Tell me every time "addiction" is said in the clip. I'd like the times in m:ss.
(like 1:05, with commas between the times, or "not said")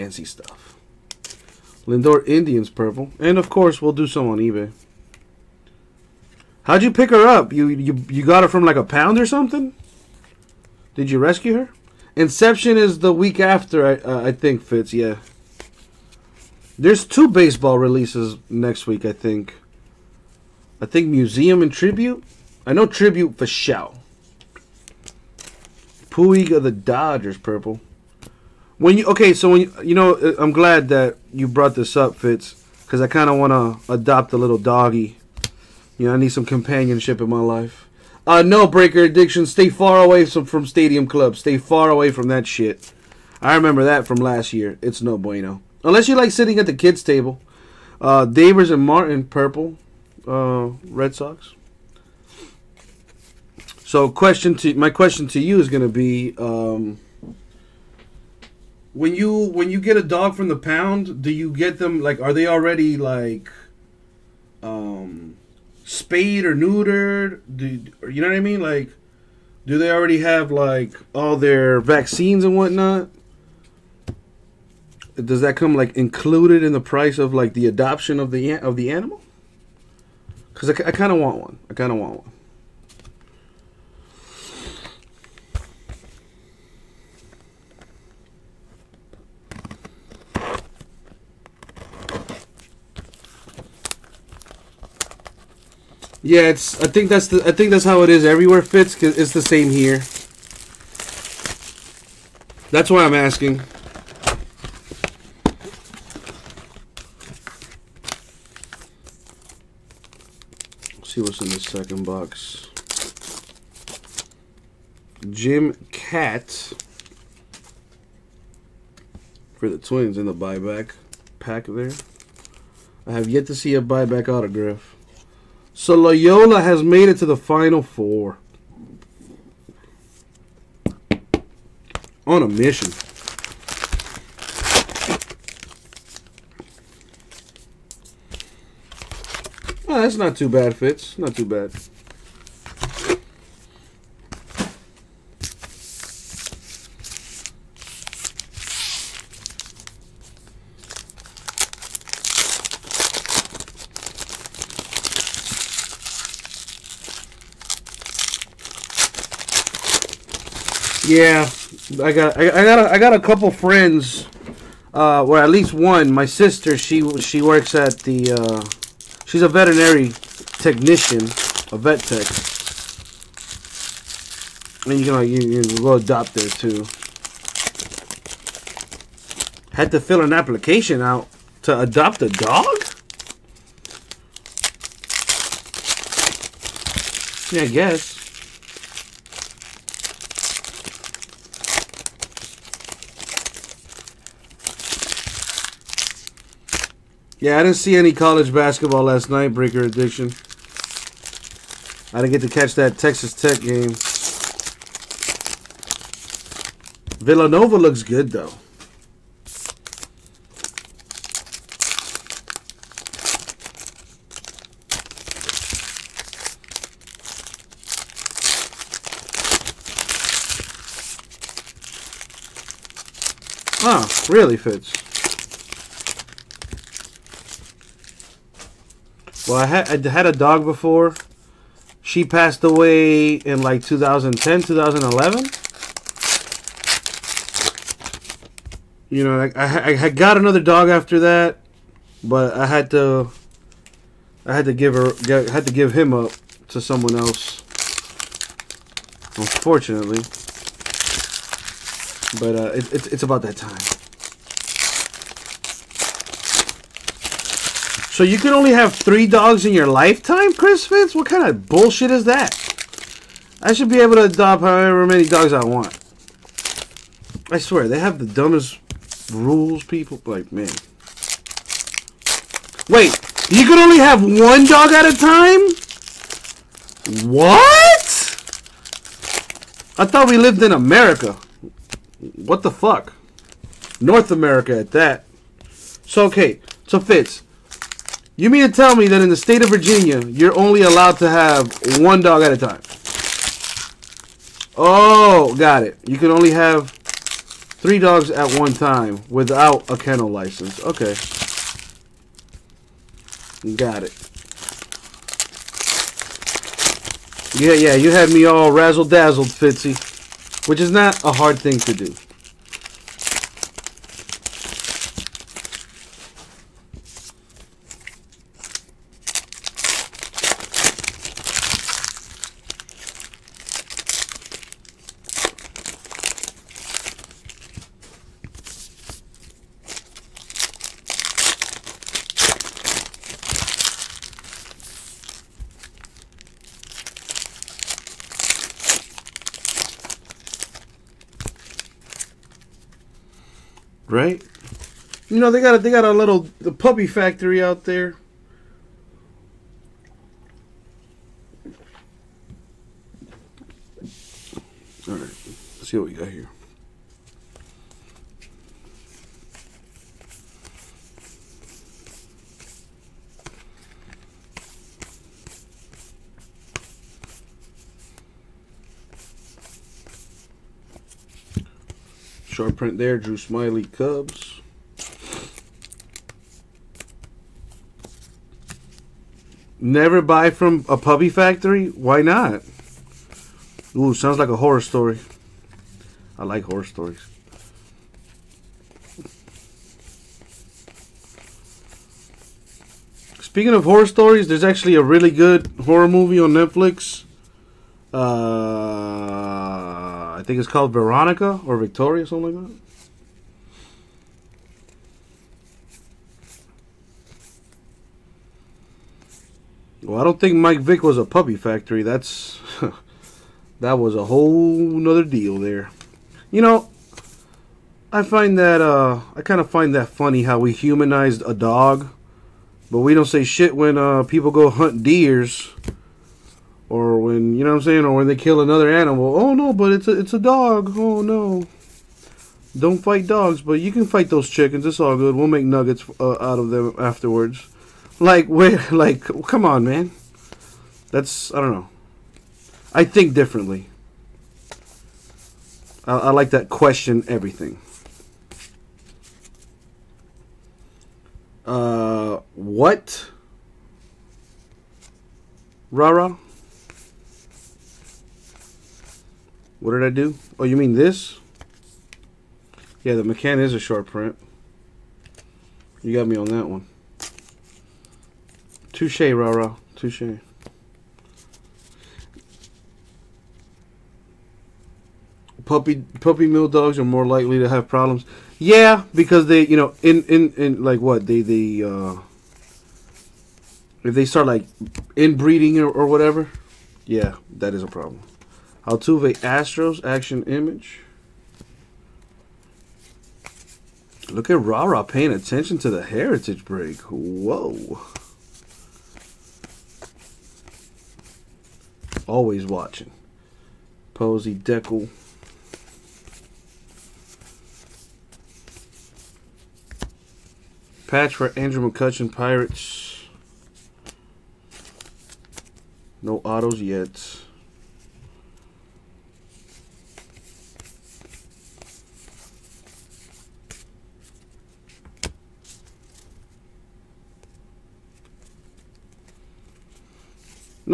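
0:39, 3:19.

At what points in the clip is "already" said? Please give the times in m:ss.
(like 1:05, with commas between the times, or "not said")
1:02, 1:09.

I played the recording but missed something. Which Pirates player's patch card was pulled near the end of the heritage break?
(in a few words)
Andrew McCutchen.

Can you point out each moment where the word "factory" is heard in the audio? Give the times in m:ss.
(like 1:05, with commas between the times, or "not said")
5:47, 6:21, 6:51.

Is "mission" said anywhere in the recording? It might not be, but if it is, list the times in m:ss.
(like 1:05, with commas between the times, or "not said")
2:12.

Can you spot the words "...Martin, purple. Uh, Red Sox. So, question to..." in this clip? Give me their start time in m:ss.
0:48.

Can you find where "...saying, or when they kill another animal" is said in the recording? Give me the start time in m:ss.
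7:07.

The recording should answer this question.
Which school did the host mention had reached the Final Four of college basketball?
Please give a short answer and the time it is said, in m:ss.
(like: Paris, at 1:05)
Loyola, at 2:05.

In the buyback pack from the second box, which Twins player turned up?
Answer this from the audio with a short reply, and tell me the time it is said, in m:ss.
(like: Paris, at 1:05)
Jim Kaat, at 1:55.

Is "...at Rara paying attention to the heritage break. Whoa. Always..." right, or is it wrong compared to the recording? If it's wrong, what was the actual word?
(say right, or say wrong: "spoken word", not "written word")
right.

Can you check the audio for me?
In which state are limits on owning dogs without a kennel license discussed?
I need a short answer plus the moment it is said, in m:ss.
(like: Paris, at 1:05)
Virginia, at 4:49.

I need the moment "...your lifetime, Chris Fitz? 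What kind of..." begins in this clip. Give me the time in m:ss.
4:19.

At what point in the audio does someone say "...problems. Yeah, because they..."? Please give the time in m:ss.
7:57.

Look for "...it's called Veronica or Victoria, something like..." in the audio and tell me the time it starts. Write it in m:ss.
6:40.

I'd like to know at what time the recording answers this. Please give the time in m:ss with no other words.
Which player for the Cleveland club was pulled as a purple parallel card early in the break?
0:01.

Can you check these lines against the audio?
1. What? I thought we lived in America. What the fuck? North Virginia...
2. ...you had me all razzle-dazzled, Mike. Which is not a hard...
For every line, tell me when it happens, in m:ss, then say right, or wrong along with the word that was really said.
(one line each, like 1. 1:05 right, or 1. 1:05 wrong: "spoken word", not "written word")
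1. 4:37 wrong: "America", not "Virginia"
2. 5:07 wrong: "Fitzy", not "Mike".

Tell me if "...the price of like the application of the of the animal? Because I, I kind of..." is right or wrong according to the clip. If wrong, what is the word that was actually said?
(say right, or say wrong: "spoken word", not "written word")
wrong: "adoption", not "application".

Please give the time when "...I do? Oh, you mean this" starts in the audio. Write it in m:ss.
7:40.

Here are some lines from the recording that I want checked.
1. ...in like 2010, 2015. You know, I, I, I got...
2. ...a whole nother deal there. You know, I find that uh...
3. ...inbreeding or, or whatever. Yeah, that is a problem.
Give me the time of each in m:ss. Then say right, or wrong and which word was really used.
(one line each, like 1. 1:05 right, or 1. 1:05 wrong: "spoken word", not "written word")
1. 3:53 wrong: "2011", not "2015"
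2. 6:54 right
3. 8:05 right.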